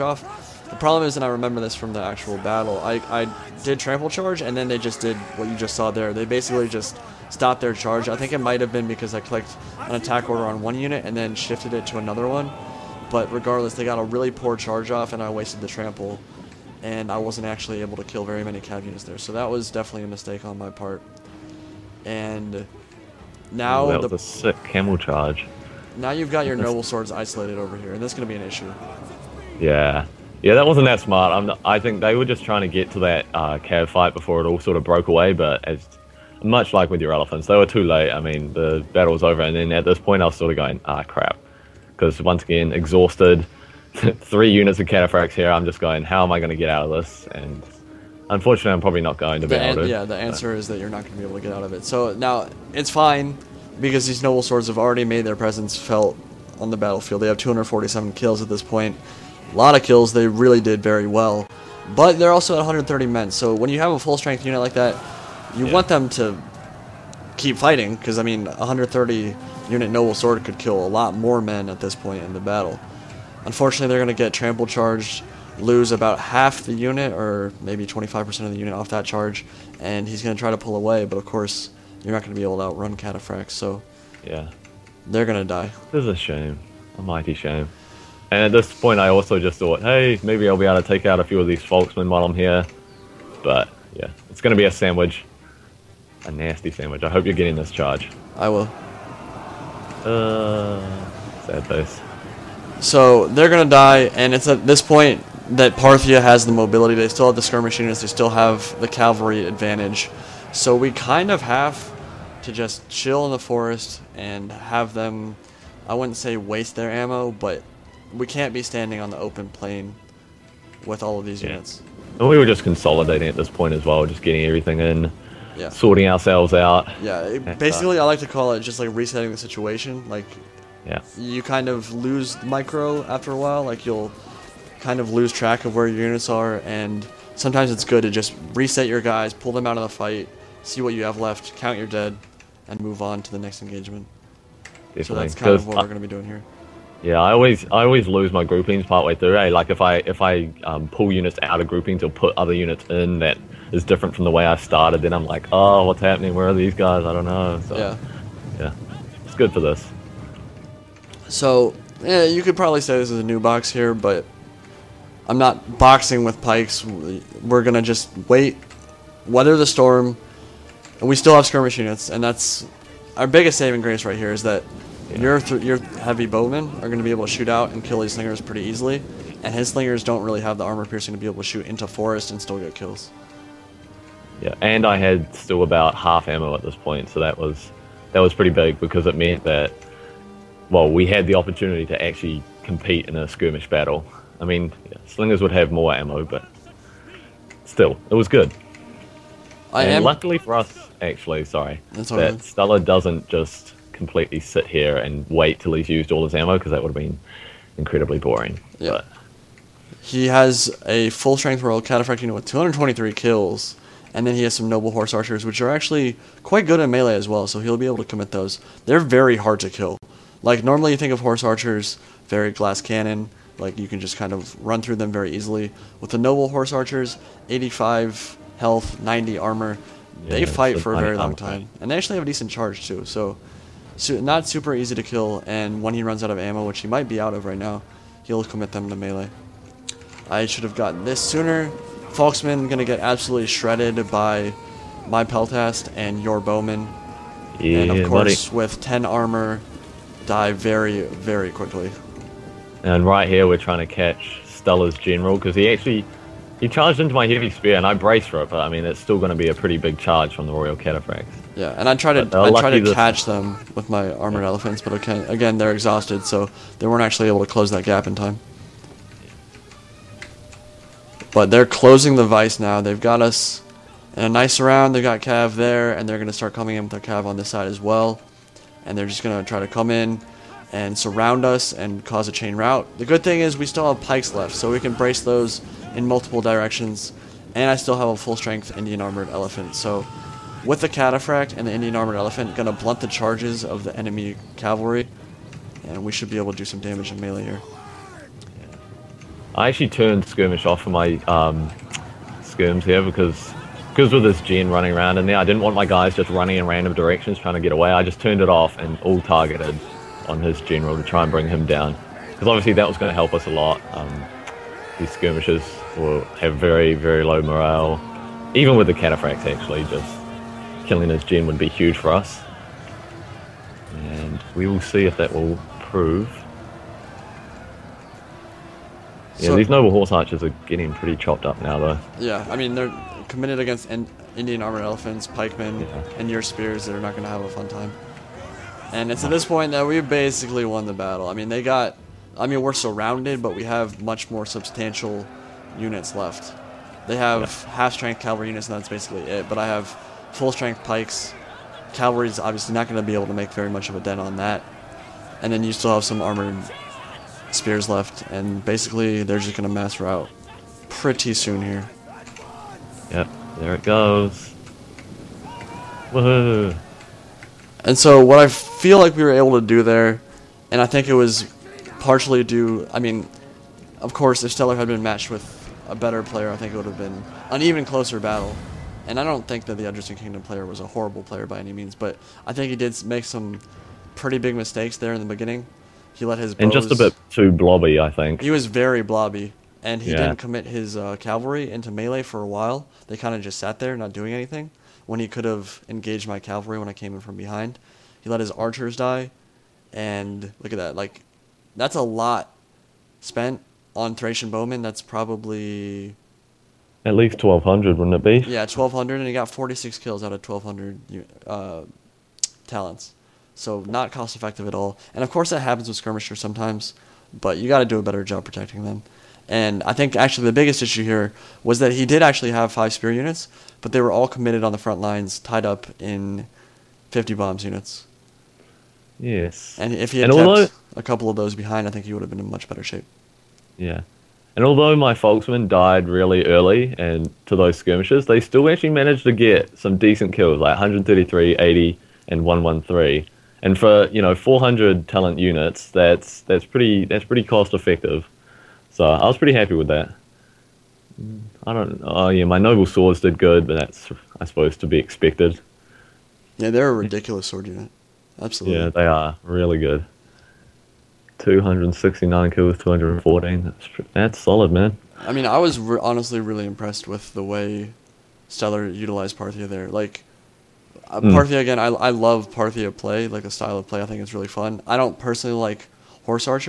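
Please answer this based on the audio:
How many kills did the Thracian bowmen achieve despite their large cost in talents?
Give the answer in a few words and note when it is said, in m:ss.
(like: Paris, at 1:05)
46, at 6:49.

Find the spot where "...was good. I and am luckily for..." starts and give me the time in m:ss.
3:18.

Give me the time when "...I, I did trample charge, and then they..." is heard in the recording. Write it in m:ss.
0:02.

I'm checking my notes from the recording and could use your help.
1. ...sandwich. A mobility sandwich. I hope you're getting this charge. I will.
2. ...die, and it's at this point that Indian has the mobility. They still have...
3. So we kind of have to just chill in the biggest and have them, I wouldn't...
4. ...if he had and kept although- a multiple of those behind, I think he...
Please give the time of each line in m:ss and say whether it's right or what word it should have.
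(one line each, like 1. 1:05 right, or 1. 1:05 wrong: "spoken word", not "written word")
1. 1:34 wrong: "nasty", not "mobility"
2. 1:43 wrong: "Parthia", not "Indian"
3. 1:50 wrong: "forest", not "biggest"
4. 7:09 wrong: "couple", not "multiple".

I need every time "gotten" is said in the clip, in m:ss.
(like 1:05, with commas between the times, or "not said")
4:00.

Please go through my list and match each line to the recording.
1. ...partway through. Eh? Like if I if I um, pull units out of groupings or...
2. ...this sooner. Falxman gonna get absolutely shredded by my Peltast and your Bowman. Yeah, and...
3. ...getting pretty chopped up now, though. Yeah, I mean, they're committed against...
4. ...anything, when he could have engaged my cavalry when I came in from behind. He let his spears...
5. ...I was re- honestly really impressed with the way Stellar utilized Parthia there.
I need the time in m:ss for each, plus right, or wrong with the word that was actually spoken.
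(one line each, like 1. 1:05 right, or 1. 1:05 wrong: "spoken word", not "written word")
1. 2:28 right
2. 4:01 right
3. 5:30 right
4. 6:34 wrong: "archers", not "spears"
5. 7:45 right.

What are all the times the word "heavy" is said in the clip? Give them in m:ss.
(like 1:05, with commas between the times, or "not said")
2:55, 4:17.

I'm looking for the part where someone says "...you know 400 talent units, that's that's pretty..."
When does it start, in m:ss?
7:24.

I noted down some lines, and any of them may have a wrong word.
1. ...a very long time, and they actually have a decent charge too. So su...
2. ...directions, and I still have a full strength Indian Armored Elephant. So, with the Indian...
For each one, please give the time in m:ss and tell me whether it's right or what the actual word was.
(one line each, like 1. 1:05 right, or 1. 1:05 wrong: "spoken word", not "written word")
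1. 3:50 right
2. 4:46 wrong: "Cataphract", not "Indian".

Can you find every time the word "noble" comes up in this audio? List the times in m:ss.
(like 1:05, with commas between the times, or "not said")
0:26, 0:54, 1:09, 3:34, 3:46, 5:29, 7:32.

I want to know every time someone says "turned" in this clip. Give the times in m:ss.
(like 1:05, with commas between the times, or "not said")
4:59, 5:08.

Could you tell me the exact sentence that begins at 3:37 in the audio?
So he'll be able to commit those.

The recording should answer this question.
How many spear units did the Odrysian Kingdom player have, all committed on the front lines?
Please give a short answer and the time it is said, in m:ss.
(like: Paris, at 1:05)
5, at 7:02.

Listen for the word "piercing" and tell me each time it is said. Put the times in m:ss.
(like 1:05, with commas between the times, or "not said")
3:00.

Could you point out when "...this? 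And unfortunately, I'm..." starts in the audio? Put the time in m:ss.
0:47.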